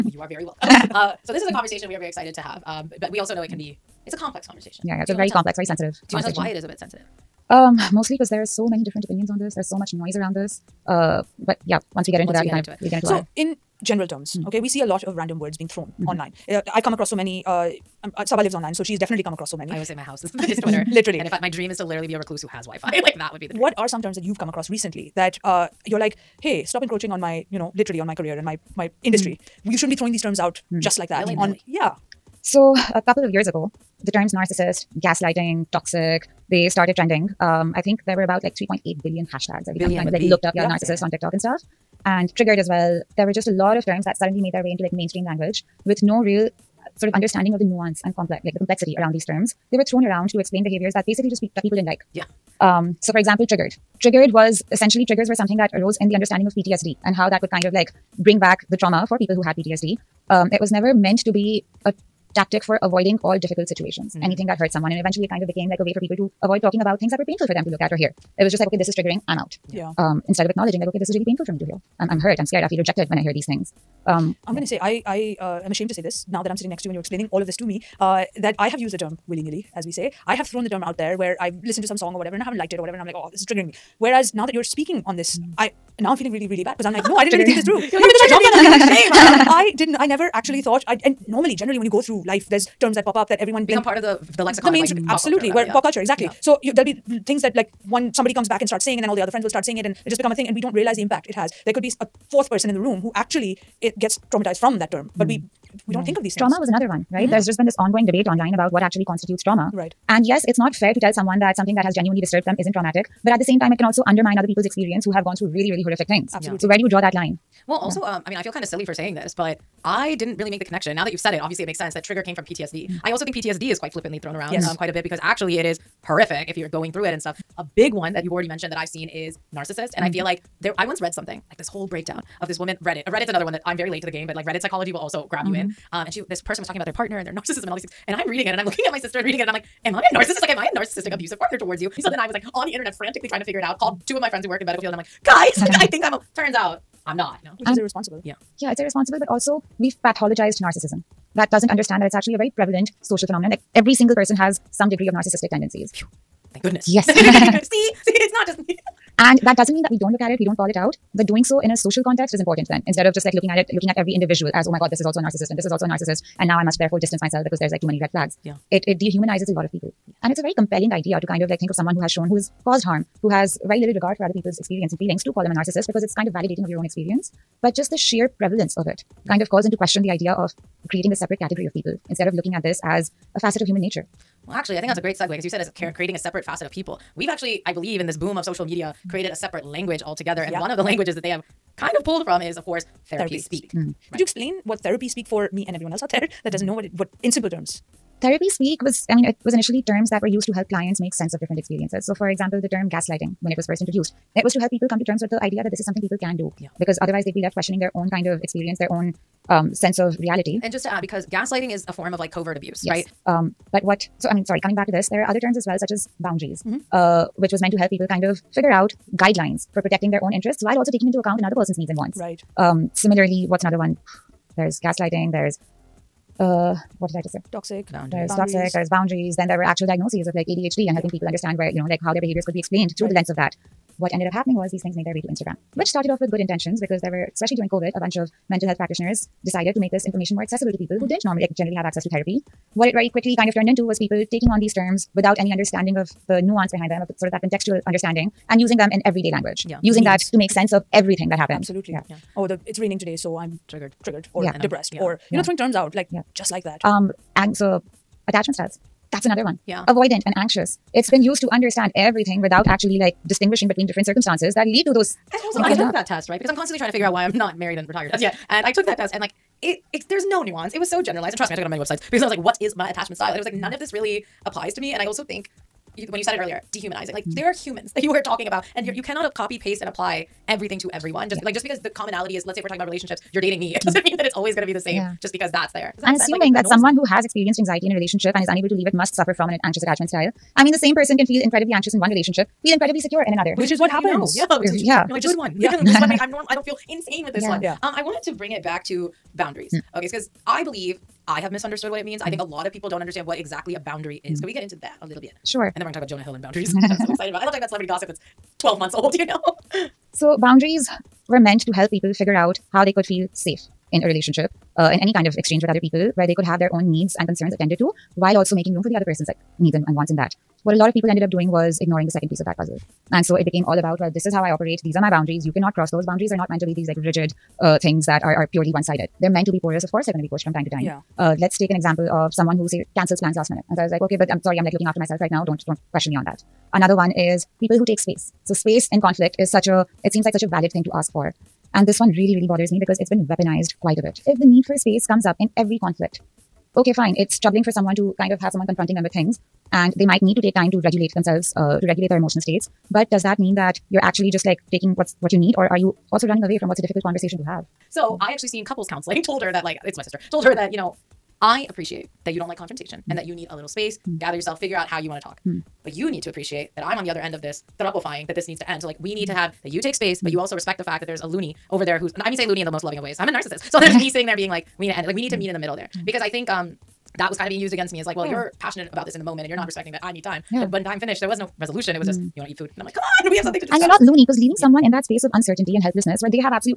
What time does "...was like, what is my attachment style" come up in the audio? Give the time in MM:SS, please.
04:32.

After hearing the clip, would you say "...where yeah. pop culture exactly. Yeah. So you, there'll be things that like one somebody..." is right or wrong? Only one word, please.
right.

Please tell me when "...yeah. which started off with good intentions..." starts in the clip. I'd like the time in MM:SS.
03:55.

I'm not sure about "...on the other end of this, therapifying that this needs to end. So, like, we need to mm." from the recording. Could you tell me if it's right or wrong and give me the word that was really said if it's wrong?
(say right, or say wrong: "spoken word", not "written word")
right.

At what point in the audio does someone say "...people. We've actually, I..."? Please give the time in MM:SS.
03:06.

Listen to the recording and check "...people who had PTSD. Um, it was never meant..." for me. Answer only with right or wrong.
right.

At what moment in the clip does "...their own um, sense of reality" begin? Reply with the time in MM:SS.
03:28.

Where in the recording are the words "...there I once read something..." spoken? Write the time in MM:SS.
02:10.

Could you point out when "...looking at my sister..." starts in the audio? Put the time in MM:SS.
02:18.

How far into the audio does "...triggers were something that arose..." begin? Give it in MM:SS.
00:55.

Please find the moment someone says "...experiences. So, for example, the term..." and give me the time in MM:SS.
03:21.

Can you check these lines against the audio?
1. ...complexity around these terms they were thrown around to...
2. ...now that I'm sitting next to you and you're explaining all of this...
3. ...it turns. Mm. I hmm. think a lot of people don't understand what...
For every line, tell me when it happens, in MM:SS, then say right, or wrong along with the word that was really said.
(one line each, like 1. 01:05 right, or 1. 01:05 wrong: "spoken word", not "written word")
1. 00:48 right
2. 01:16 right
3. 05:01 wrong: "means", not "turns".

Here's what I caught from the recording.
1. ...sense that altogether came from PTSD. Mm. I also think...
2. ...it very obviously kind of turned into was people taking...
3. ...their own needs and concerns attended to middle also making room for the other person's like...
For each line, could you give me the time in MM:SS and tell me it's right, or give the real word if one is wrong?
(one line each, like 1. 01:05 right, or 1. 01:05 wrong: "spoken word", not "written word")
1. 02:01 wrong: "trigger", not "altogether"
2. 04:02 wrong: "quickly", not "obviously"
3. 05:16 wrong: "while", not "middle".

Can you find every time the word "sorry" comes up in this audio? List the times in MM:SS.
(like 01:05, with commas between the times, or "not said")
03:34, 05:34.